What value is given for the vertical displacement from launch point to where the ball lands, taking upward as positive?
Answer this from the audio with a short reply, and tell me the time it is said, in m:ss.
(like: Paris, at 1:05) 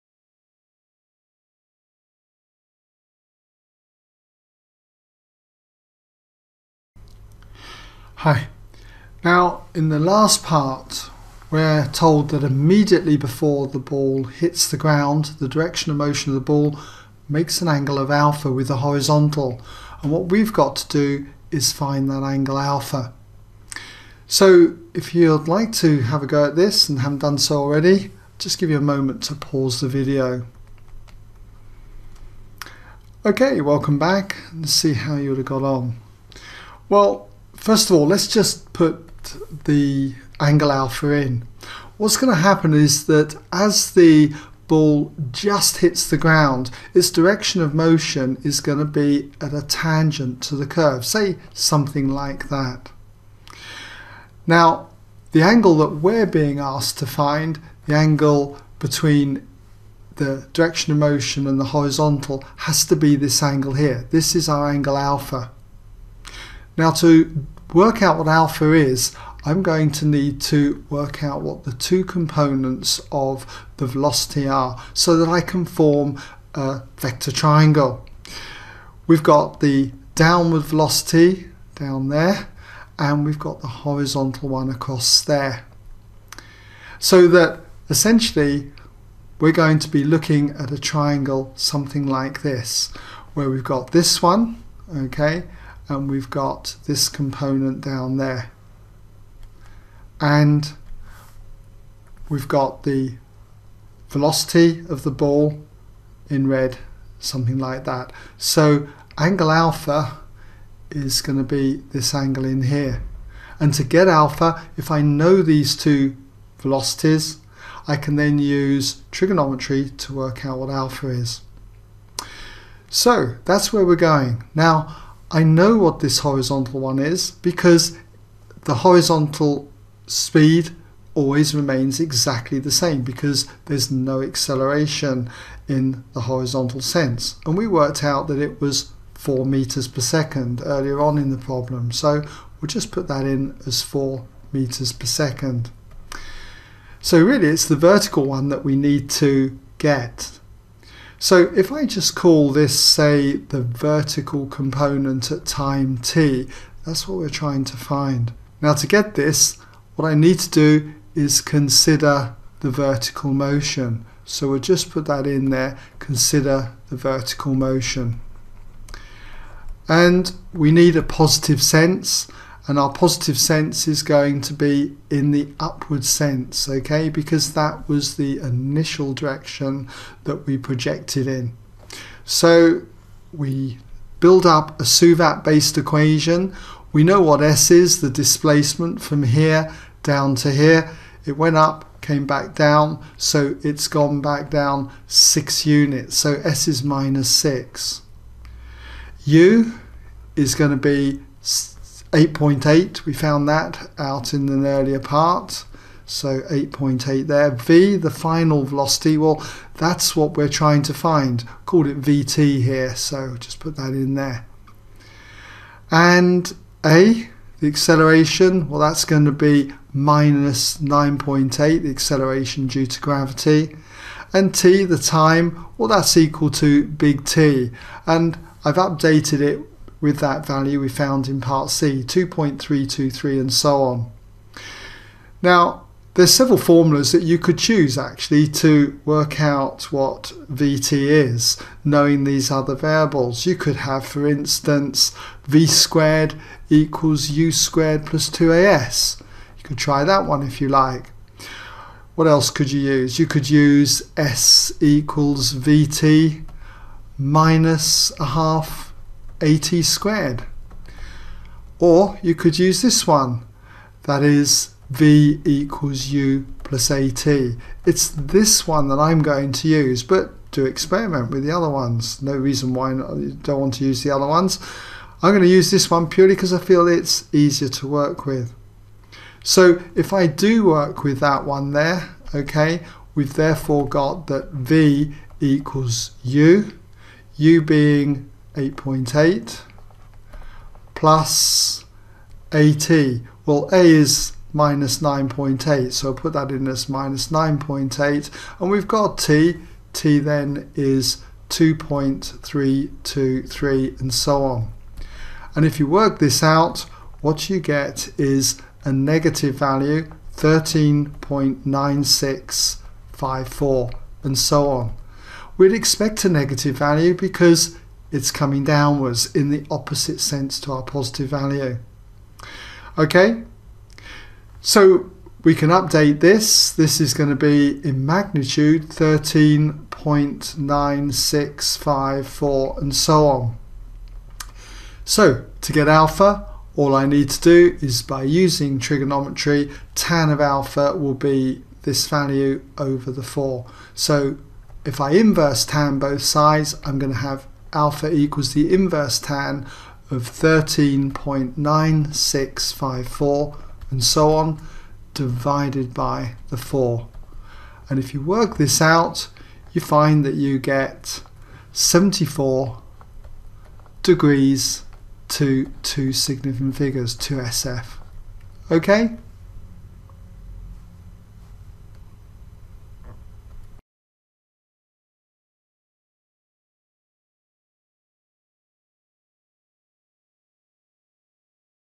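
-6, at 3:16.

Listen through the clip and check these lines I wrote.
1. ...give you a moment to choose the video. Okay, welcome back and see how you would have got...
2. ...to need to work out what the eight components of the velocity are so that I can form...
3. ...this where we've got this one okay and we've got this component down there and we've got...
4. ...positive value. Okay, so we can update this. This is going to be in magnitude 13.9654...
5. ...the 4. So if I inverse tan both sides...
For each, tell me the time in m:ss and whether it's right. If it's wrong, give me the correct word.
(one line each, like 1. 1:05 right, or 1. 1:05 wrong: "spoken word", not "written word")
1. 0:28 wrong: "pause", not "choose"
2. 1:09 wrong: "two", not "eight"
3. 1:32 right
4. 5:20 right
5. 5:43 right.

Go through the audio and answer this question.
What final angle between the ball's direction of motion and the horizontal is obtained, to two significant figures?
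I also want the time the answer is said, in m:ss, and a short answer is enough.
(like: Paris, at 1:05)
74 degrees, at 6:01.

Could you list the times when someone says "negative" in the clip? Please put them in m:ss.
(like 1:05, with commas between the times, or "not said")
5:08, 5:16.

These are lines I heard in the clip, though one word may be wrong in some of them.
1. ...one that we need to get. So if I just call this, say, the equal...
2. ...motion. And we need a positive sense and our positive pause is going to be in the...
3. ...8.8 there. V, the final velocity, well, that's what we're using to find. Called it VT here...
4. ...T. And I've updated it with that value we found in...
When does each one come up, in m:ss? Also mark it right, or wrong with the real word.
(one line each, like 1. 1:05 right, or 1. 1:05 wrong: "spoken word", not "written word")
1. 2:28 wrong: "vertical", not "equal"
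2. 2:47 wrong: "sense", not "pause"
3. 3:26 wrong: "trying", not "using"
4. 3:47 right.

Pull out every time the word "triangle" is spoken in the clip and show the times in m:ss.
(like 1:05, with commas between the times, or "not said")
1:17, 1:30.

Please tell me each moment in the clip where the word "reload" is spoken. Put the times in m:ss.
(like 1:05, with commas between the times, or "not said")
not said.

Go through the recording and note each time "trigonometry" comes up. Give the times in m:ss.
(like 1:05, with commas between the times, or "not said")
1:59, 5:38.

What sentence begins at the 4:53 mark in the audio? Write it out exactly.
Well, A is minus 9.8, so put that in as minus 9.8.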